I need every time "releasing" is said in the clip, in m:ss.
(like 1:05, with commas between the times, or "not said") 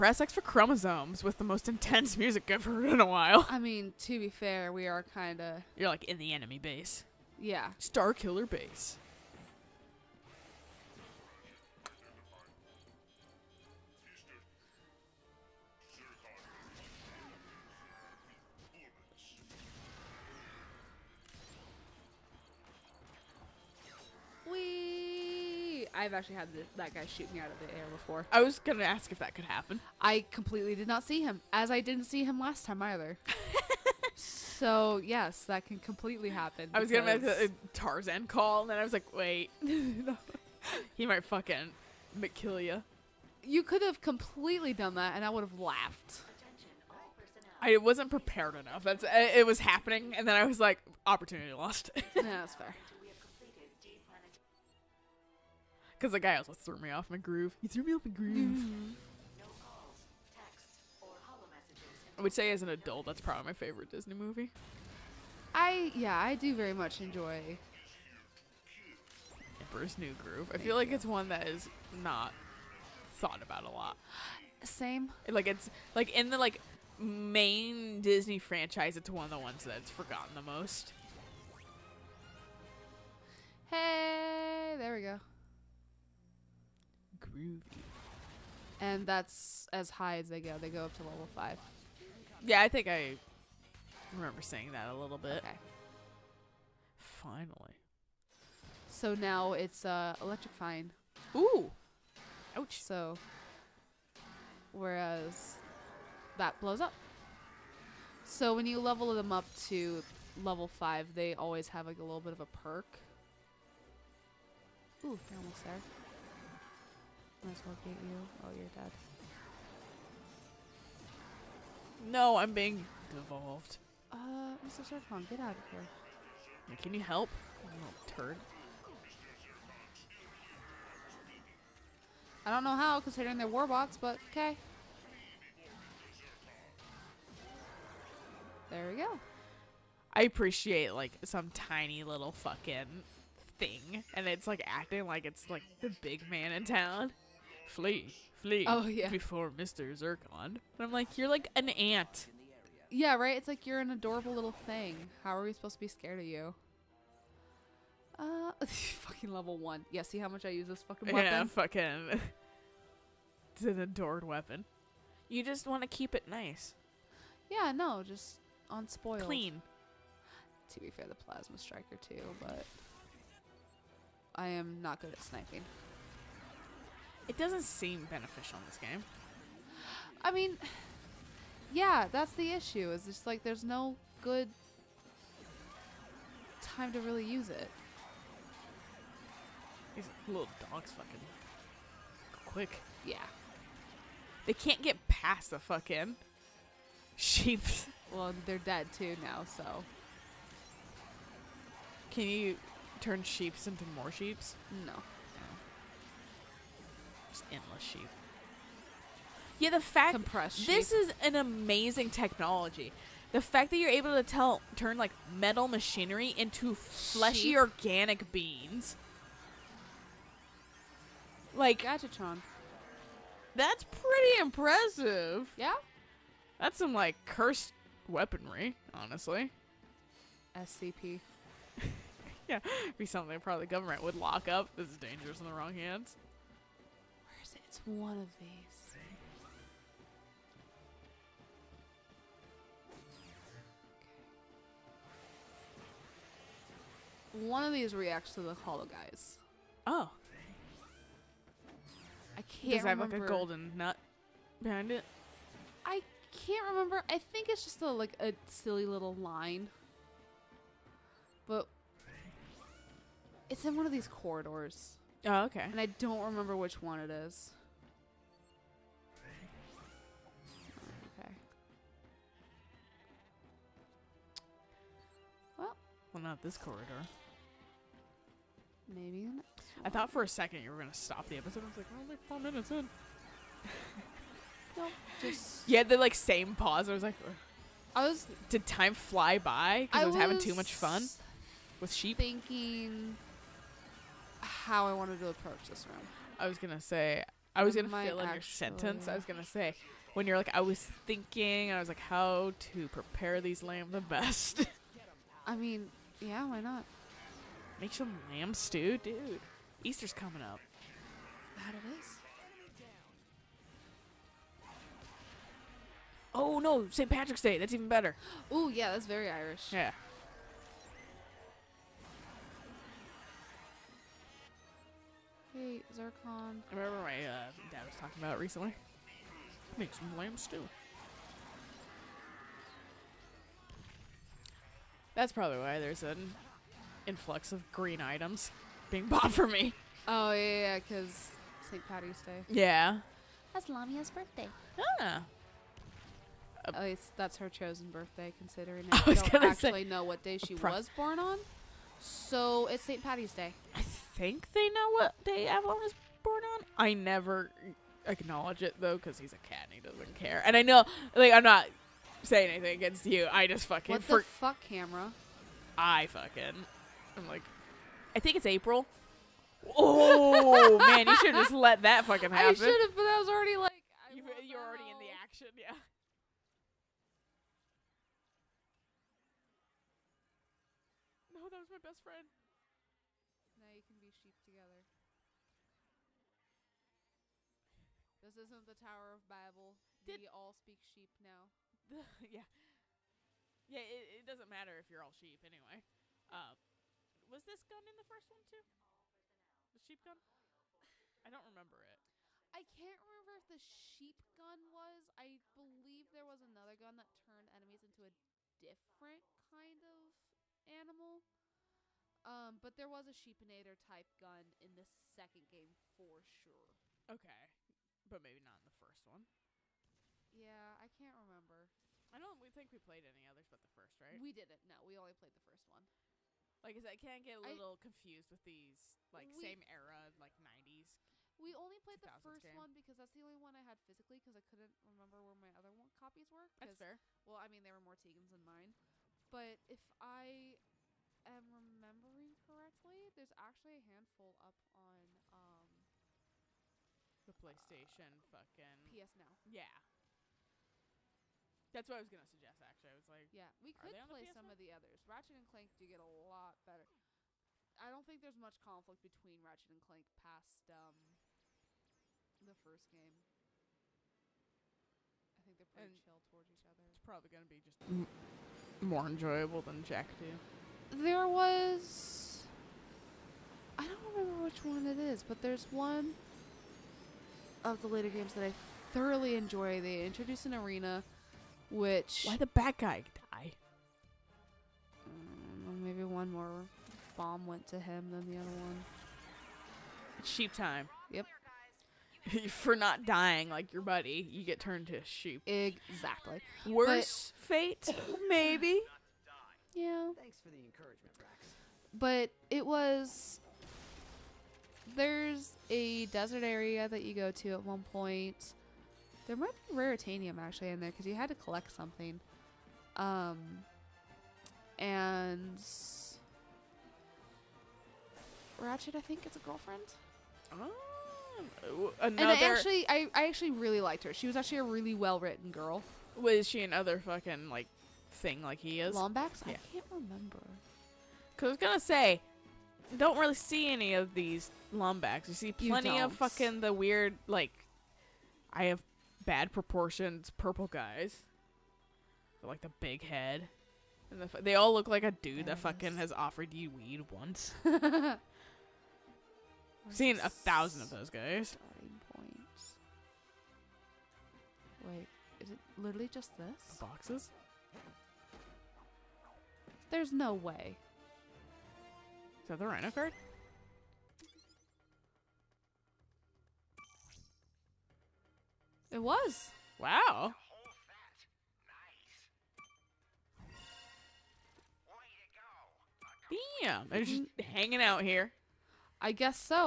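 not said.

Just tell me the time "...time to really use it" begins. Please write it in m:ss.
3:06.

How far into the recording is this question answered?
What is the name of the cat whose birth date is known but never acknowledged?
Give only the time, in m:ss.
5:55.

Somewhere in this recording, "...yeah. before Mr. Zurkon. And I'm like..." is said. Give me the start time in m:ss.
2:28.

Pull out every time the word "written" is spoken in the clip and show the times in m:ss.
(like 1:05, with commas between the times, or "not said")
8:45.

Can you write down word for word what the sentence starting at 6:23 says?
Now you can be sheep together.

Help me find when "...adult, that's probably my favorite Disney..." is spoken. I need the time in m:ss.
1:02.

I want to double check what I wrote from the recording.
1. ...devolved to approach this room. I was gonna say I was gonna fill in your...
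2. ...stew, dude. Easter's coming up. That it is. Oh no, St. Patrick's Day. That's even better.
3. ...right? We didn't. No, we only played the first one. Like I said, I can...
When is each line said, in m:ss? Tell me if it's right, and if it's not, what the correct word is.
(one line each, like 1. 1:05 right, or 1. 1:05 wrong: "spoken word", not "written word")
1. 4:54 wrong: "wanted", not "devolved"
2. 5:08 right
3. 7:04 right.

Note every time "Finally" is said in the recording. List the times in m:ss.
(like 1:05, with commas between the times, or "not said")
1:36.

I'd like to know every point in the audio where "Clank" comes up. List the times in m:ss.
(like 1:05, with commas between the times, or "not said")
7:35, 7:39.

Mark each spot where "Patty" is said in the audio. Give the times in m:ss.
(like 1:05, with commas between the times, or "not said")
5:41, 5:53.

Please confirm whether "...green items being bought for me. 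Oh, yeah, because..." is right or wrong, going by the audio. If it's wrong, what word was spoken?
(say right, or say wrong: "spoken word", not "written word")
right.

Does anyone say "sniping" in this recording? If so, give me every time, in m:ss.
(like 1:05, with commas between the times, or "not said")
2:55.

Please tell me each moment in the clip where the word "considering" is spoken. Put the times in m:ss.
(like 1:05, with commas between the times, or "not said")
2:12, 5:48.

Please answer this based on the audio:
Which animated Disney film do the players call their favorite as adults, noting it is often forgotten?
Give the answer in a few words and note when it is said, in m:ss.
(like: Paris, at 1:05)
Emperor's New Groove, at 1:09.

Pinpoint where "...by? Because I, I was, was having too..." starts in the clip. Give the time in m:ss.
4:49.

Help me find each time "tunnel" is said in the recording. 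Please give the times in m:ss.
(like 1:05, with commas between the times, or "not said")
not said.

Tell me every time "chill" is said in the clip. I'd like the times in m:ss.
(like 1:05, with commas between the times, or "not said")
7:46.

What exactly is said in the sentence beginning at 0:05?
You're like in the enemy base.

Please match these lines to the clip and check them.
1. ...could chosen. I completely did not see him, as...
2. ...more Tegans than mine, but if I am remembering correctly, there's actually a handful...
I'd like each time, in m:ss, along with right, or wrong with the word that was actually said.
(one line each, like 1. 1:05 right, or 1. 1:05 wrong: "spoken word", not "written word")
1. 0:29 wrong: "happen", not "chosen"
2. 7:17 right.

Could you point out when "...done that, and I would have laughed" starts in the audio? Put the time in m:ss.
0:44.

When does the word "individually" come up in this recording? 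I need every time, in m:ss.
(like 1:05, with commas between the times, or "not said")
not said.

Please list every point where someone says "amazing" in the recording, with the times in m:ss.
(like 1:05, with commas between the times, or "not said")
3:31.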